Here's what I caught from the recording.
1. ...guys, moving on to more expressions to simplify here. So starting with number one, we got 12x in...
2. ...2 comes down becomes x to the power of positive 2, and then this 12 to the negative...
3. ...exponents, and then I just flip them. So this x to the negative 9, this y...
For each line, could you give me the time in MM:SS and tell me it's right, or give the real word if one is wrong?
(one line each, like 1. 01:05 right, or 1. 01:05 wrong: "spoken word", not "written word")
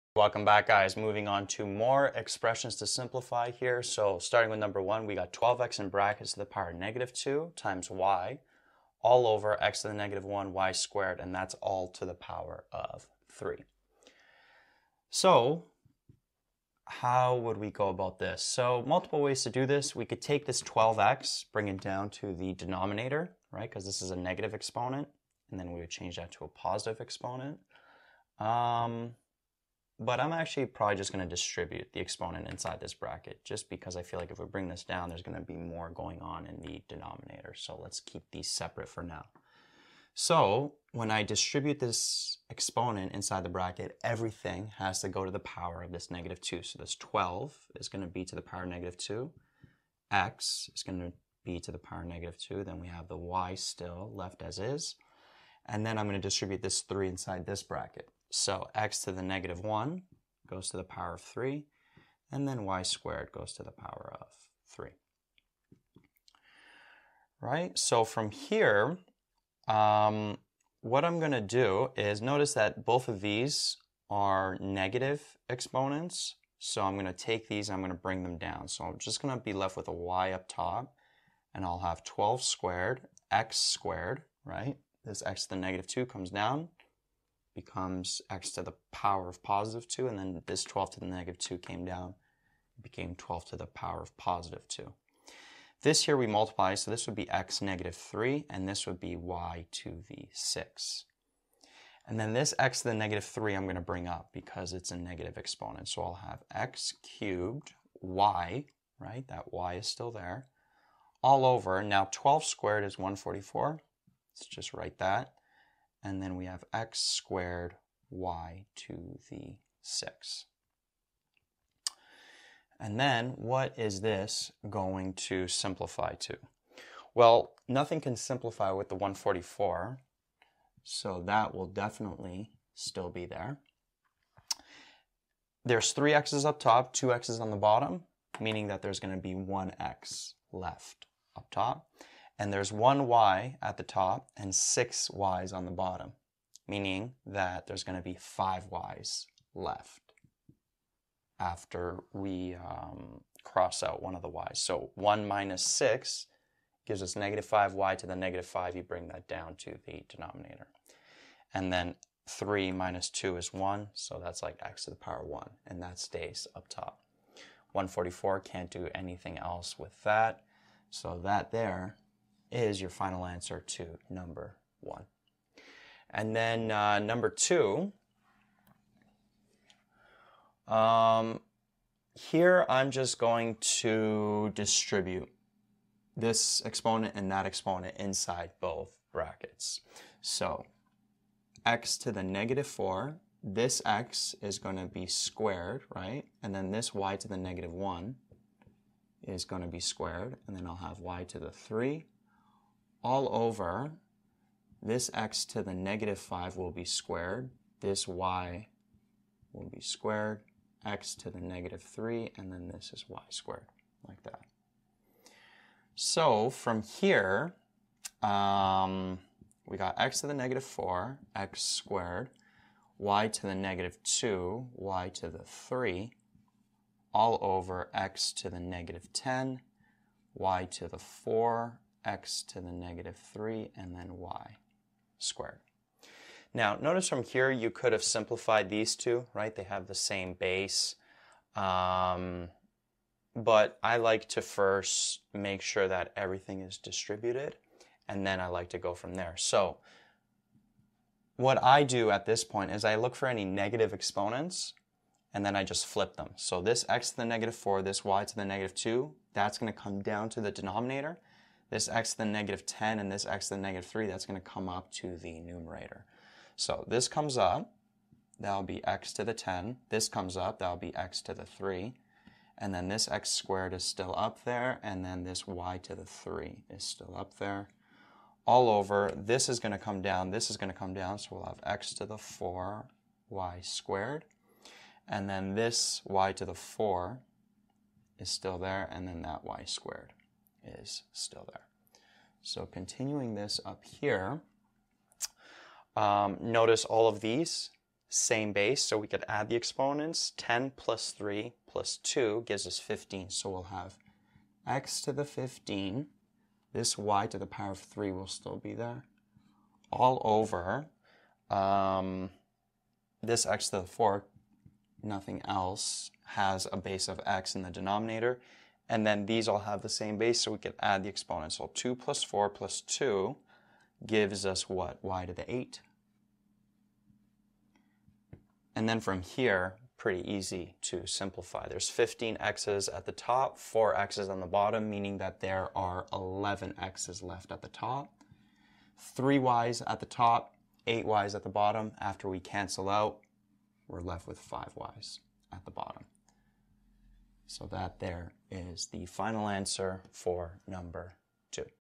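1. 00:00 right
2. 01:25 right
3. 04:13 wrong: "4", not "9".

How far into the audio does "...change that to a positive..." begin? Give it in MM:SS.
00:25.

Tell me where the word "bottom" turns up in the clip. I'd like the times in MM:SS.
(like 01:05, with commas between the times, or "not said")
02:17, 02:25, 05:34, 05:41, 05:45.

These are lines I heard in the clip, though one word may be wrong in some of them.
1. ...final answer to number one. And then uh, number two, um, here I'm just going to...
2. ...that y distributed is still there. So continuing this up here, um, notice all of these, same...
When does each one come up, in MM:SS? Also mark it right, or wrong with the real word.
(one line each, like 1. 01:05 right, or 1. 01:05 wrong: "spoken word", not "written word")
1. 02:52 right
2. 04:49 wrong: "squared", not "distributed".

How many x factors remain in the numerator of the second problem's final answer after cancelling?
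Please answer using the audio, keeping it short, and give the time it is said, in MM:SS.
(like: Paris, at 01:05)
11, at 05:36.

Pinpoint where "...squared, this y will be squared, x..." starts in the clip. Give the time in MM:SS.
03:26.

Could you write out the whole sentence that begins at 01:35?
This here we multiply, so this would be x negative 3, and this would be y to the 6.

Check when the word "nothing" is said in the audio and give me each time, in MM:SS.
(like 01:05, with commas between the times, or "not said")
02:07, 05:15.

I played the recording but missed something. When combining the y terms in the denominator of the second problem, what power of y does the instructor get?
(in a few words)
8.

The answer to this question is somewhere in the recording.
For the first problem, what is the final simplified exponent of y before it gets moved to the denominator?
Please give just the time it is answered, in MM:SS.
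02:37.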